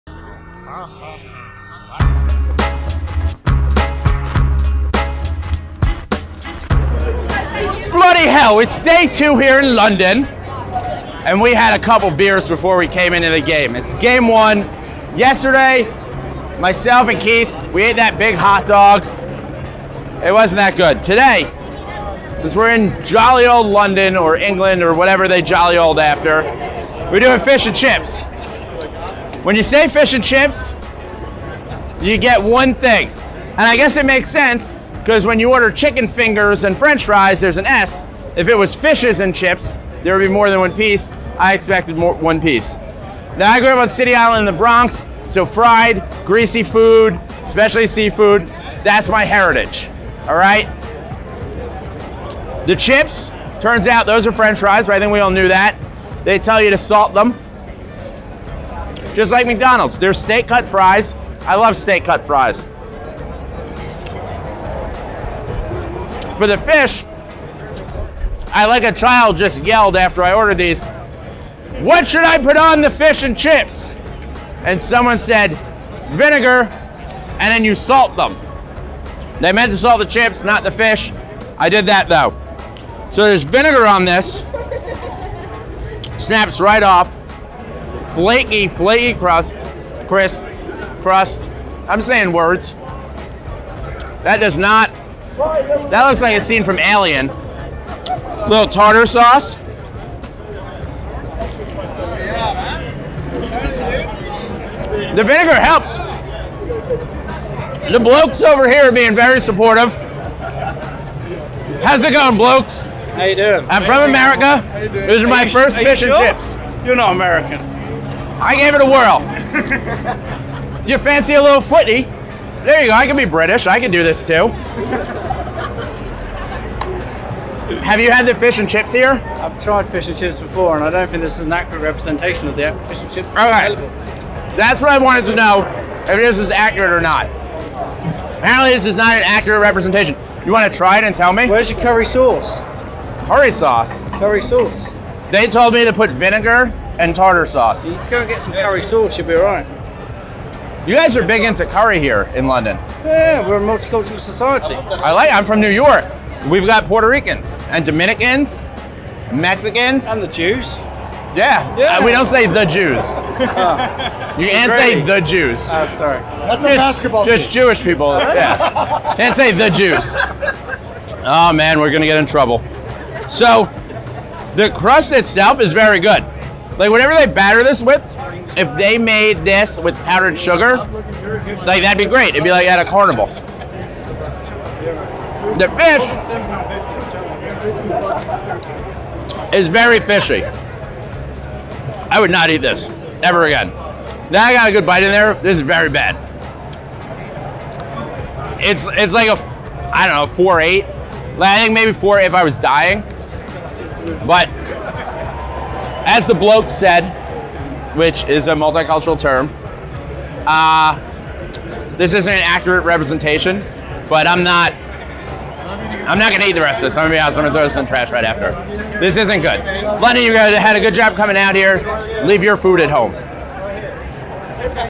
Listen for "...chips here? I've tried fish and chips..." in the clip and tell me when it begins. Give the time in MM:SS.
02:08.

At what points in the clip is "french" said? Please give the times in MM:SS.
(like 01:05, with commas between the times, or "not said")
00:36, 00:54.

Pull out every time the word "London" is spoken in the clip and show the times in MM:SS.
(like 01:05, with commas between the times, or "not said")
00:09, 00:23, 02:32.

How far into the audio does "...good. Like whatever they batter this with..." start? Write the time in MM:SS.
02:55.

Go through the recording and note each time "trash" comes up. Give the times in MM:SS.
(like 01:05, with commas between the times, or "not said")
03:37.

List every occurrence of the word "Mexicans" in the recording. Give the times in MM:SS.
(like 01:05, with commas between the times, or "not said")
02:39.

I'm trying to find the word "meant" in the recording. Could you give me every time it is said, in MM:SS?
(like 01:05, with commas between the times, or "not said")
01:19.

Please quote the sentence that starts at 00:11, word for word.
And we had a couple beers before we came into the game.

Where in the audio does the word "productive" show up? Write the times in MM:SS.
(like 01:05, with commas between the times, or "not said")
not said.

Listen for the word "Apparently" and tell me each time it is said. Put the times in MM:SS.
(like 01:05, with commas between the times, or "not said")
02:18.